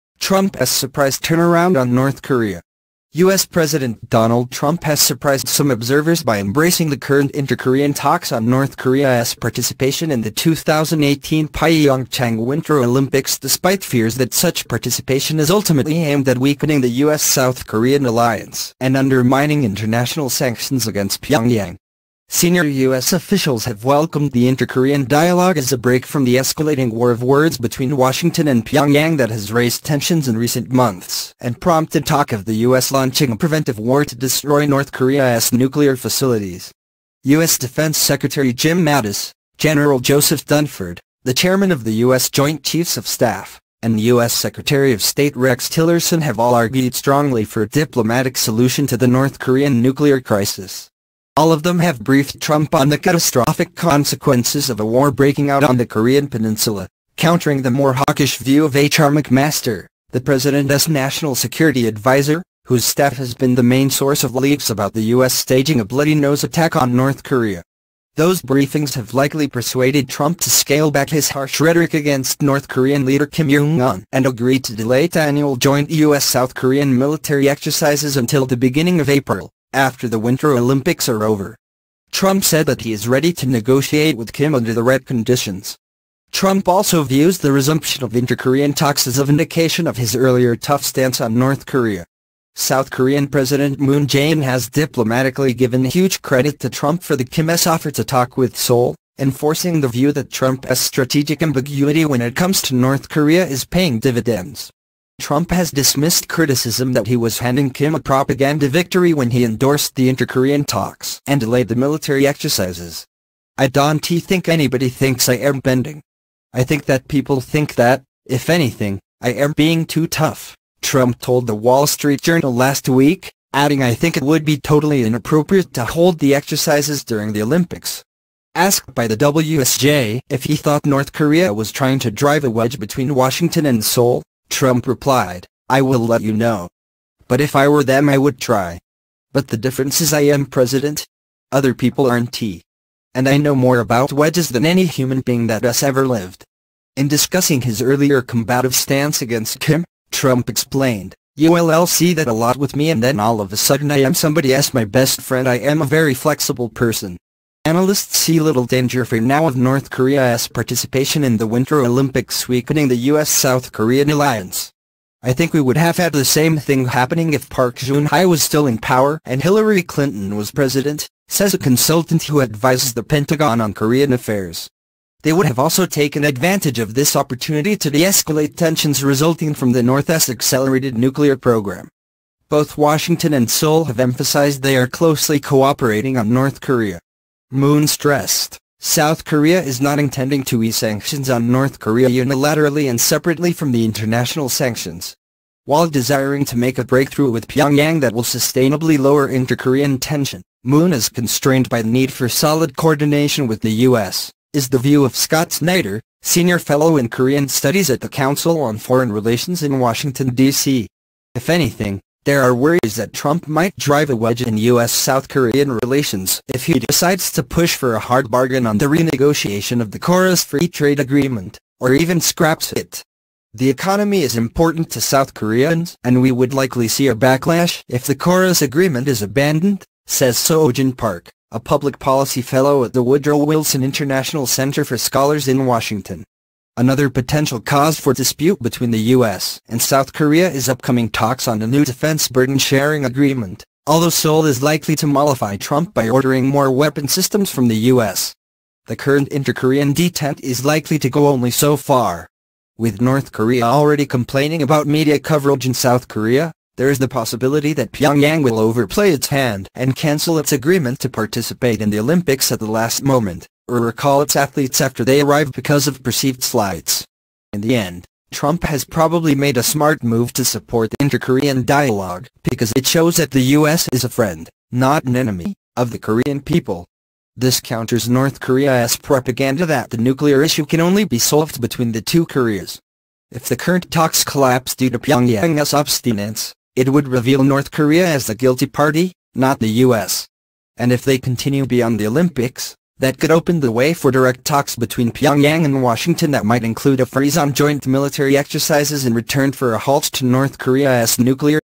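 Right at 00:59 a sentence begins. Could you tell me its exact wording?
McMaster, the president's national security advisor, whose staff has been the main source of leaks about the U.S.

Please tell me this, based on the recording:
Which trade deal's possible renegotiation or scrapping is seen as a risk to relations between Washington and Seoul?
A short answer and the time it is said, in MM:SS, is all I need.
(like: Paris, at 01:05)
KORUS Free Trade Agreement, at 03:39.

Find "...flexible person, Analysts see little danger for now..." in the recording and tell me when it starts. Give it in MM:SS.
02:36.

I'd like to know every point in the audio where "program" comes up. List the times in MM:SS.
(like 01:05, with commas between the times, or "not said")
03:01.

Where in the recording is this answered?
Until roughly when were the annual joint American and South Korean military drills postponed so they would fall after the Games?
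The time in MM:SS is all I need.
01:18.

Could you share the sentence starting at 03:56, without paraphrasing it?
Another potential cause for dispute between the U.S.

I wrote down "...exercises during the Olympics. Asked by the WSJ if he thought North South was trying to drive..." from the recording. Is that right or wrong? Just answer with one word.
wrong.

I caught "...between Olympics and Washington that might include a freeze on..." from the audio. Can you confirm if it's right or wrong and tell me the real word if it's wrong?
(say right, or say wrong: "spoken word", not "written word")
wrong: "Pyongyang", not "Olympics".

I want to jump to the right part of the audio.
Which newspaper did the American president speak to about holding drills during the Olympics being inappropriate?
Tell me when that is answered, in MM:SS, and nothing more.
02:01.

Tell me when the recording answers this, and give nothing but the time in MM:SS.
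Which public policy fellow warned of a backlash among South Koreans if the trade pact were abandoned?
03:50.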